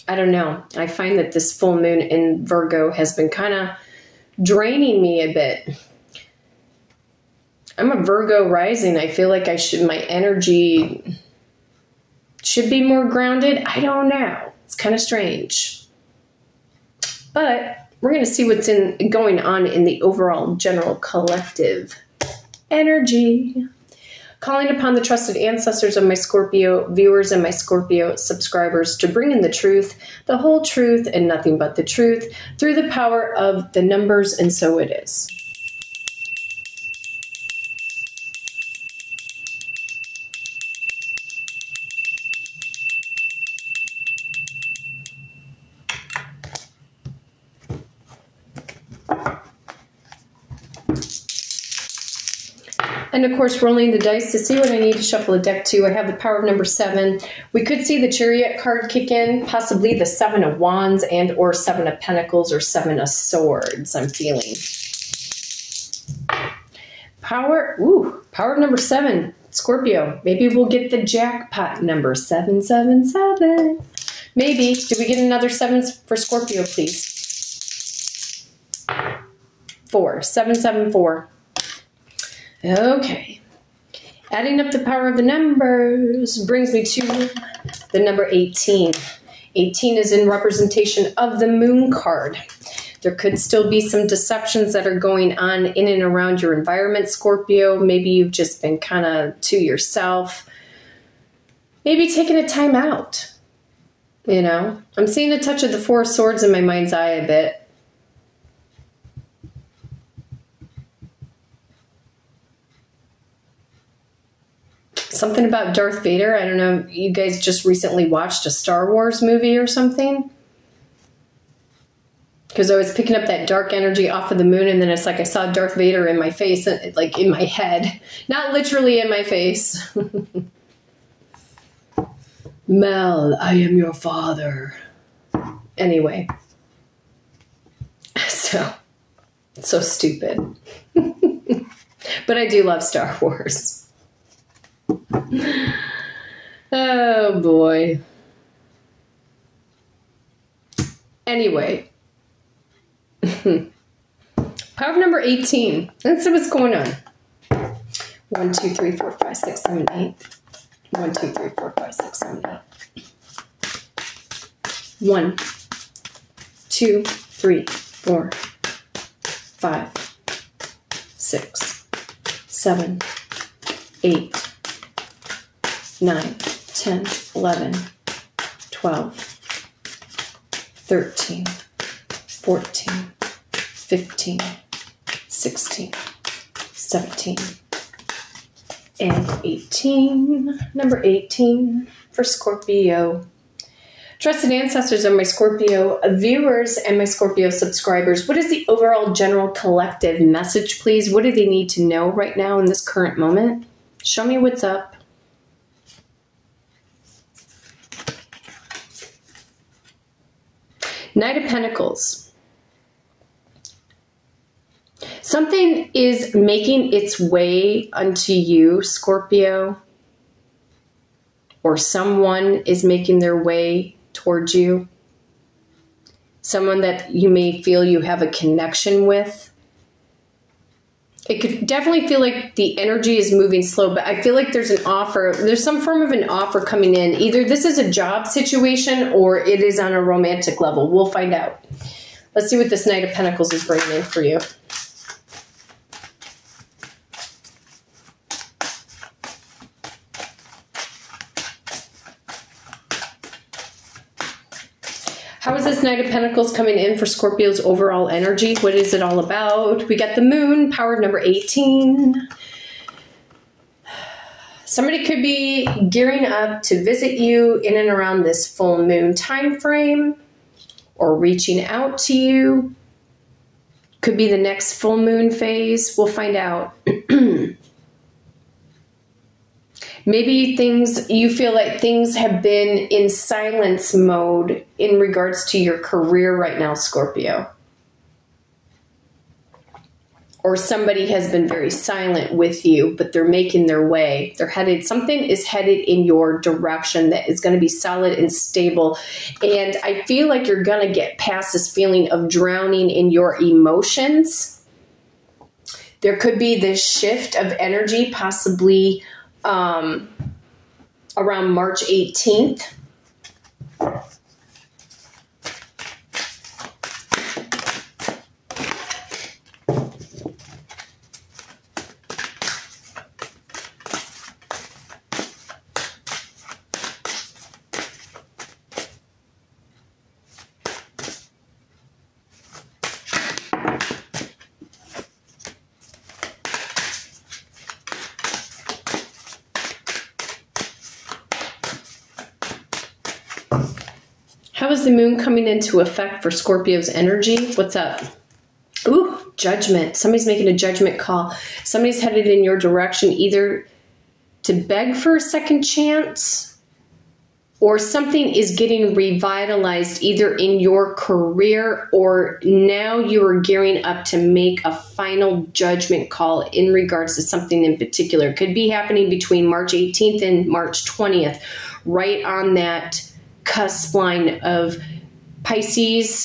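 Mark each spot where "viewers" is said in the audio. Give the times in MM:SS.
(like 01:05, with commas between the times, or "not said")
00:26, 03:16.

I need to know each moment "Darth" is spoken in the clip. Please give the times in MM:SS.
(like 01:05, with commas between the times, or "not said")
01:55, 02:05.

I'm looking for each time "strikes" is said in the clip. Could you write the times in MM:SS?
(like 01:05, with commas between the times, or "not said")
not said.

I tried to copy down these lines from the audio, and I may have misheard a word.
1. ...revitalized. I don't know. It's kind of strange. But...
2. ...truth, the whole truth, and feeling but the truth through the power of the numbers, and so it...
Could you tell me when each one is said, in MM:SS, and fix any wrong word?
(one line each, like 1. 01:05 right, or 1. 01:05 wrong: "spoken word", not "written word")
1. 00:13 wrong: "grounded", not "revitalized"
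2. 00:29 wrong: "nothing", not "feeling".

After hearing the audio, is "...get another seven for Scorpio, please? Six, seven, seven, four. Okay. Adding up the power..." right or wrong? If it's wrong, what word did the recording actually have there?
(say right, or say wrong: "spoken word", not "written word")
wrong: "Four", not "Six".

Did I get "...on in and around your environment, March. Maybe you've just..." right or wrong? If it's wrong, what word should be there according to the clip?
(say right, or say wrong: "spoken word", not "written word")
wrong: "Scorpio", not "March".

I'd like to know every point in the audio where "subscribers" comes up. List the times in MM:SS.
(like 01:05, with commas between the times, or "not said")
00:28, 03:17.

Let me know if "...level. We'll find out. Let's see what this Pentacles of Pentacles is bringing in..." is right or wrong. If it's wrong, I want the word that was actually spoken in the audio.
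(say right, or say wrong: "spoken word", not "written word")
wrong: "Knight", not "Pentacles".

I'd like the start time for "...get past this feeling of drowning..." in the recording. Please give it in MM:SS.
05:00.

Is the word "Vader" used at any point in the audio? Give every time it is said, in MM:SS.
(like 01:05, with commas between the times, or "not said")
01:56, 02:05.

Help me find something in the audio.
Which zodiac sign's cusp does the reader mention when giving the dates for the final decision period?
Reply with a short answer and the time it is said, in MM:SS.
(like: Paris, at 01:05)
Pisces, at 06:15.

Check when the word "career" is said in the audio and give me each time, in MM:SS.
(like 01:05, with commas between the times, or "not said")
04:45, 06:00.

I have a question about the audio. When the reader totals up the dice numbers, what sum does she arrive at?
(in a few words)
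18.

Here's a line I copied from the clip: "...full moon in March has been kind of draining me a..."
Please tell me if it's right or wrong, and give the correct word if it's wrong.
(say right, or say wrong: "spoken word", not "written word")
wrong: "Virgo", not "March".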